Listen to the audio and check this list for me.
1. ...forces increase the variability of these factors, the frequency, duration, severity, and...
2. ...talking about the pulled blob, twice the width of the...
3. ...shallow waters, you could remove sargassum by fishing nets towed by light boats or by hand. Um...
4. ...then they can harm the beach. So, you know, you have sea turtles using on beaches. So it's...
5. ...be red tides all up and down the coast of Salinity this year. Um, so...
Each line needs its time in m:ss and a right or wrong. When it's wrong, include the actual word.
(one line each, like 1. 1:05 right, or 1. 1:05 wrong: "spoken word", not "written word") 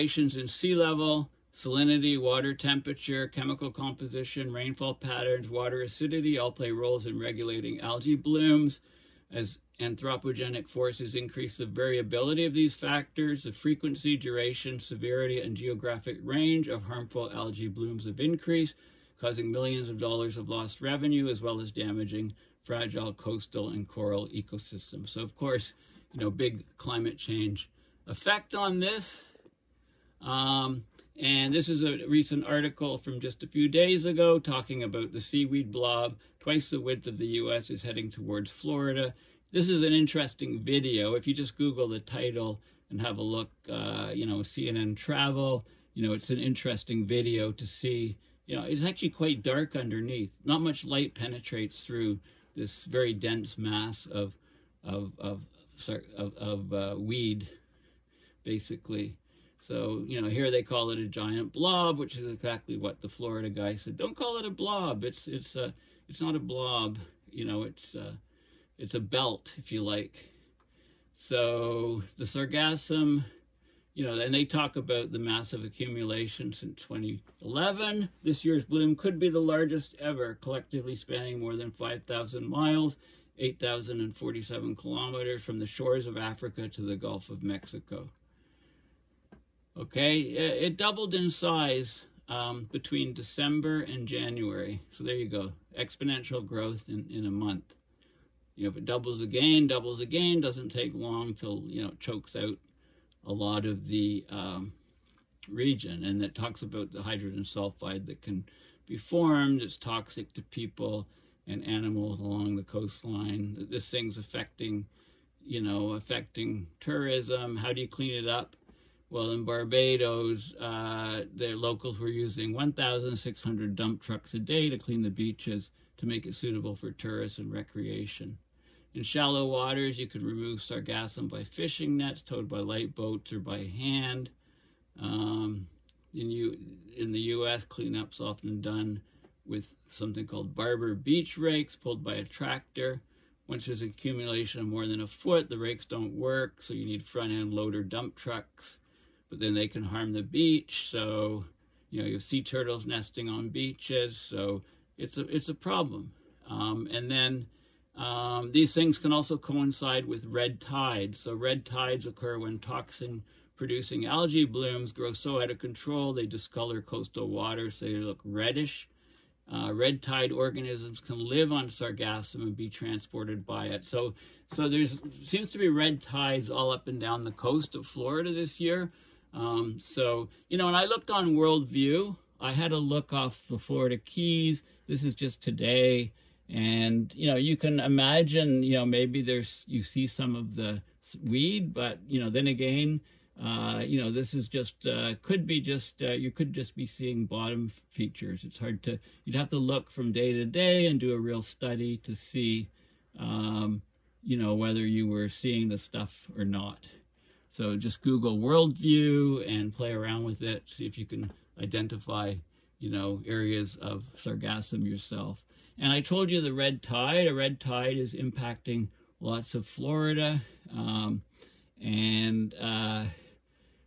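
1. 0:10 right
2. 0:34 wrong: "seaweed", not "pulled"
3. 2:09 right
4. 2:29 wrong: "nesting", not "using"
5. 2:55 wrong: "Florida", not "Salinity".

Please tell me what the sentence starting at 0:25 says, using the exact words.
So of course, you know, big climate change effect on this.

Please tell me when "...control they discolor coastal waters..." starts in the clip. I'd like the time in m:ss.
2:45.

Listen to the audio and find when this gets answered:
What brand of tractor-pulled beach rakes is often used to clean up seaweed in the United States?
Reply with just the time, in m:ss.
2:20.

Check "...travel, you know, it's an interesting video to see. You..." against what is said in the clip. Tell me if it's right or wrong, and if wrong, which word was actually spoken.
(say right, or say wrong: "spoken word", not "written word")
right.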